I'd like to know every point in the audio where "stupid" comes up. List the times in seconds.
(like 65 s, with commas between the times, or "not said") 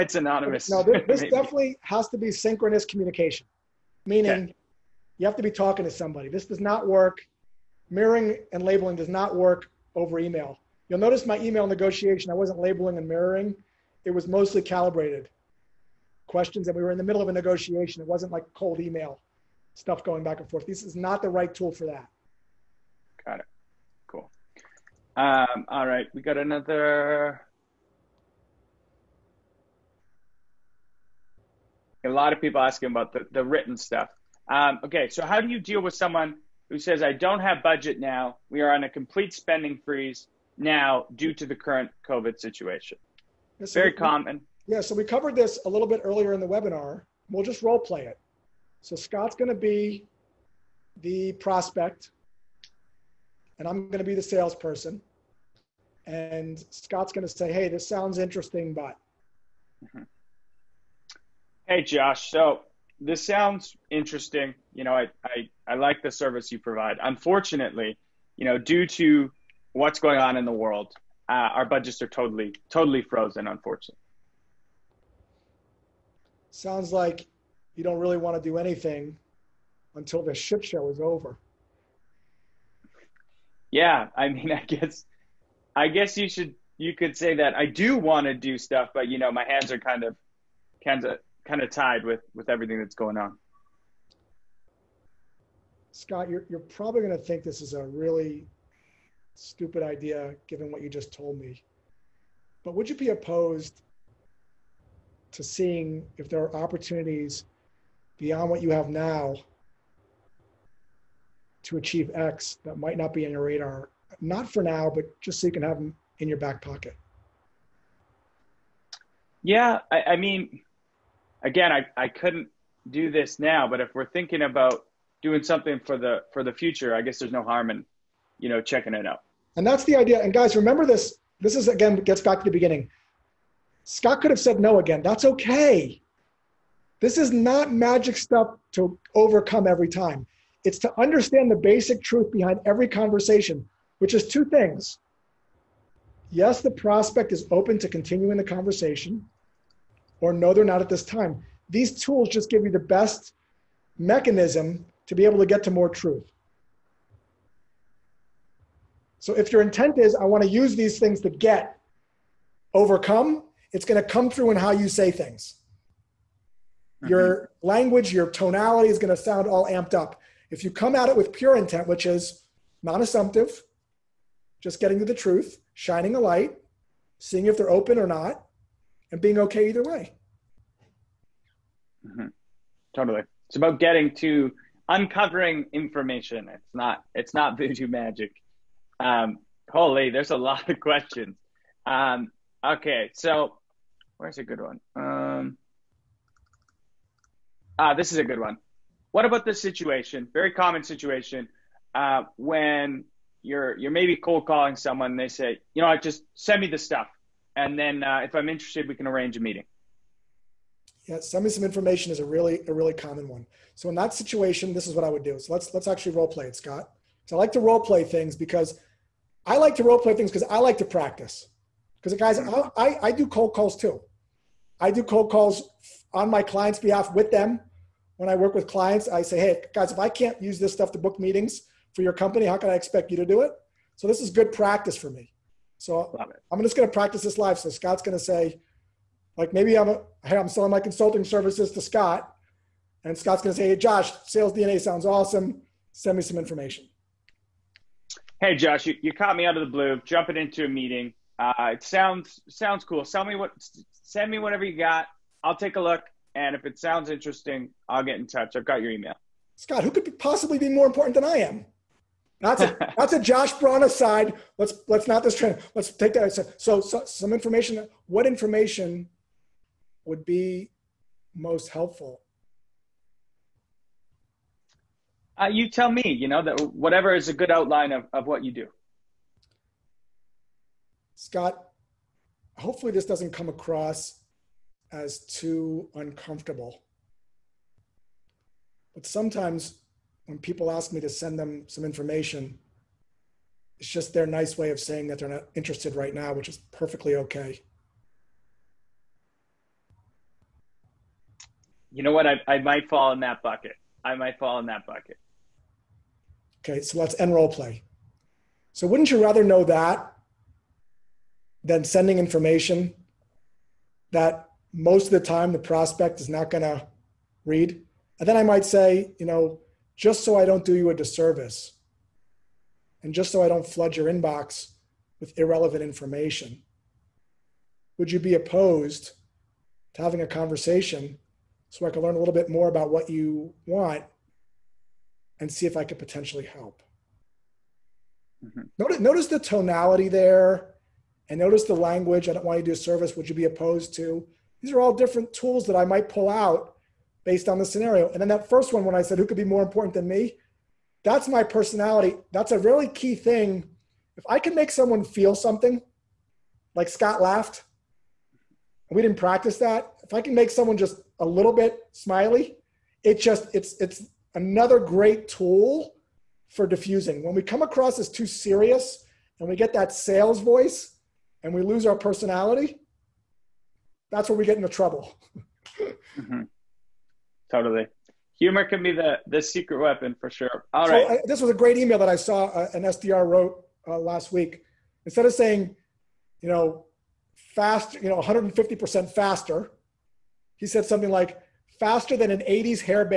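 99 s.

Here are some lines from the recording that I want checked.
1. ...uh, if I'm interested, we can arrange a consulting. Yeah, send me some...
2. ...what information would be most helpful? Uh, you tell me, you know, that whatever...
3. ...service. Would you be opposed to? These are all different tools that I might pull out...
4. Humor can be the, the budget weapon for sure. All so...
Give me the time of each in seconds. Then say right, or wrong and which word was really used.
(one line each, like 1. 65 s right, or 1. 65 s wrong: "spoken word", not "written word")
1. 208 s wrong: "meeting", not "consulting"
2. 268 s right
3. 342 s right
4. 378 s wrong: "secret", not "budget".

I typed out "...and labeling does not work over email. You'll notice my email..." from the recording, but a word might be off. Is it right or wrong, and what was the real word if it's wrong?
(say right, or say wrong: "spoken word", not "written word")
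right.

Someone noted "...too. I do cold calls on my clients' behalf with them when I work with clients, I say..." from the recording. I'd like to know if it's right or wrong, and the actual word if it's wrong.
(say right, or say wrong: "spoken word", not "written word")
right.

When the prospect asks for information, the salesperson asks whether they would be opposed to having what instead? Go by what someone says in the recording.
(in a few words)
a conversation.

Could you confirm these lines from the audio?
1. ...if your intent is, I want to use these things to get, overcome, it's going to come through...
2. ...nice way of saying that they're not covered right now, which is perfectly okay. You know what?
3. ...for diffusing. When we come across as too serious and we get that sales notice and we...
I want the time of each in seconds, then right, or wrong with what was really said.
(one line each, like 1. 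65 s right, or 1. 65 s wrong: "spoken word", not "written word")
1. 159 s right
2. 294 s wrong: "interested", not "covered"
3. 366 s wrong: "voice", not "notice".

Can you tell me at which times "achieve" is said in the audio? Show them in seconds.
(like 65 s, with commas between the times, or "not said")
111 s.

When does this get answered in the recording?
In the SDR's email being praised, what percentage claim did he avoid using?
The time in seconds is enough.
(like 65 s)
388 s.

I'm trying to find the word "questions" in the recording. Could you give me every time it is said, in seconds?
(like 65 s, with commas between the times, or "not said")
16 s, 190 s.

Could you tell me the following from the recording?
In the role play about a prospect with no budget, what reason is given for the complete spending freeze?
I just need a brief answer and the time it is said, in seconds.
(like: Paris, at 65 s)
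COVID, at 41 s.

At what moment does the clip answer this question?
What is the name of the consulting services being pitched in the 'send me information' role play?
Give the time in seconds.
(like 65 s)
244 s.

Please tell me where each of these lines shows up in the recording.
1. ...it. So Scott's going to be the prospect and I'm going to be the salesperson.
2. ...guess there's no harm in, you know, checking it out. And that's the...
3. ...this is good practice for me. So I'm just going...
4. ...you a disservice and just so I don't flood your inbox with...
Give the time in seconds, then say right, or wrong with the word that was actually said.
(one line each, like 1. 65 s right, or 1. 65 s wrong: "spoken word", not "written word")
1. 48 s right
2. 127 s right
3. 234 s right
4. 320 s right.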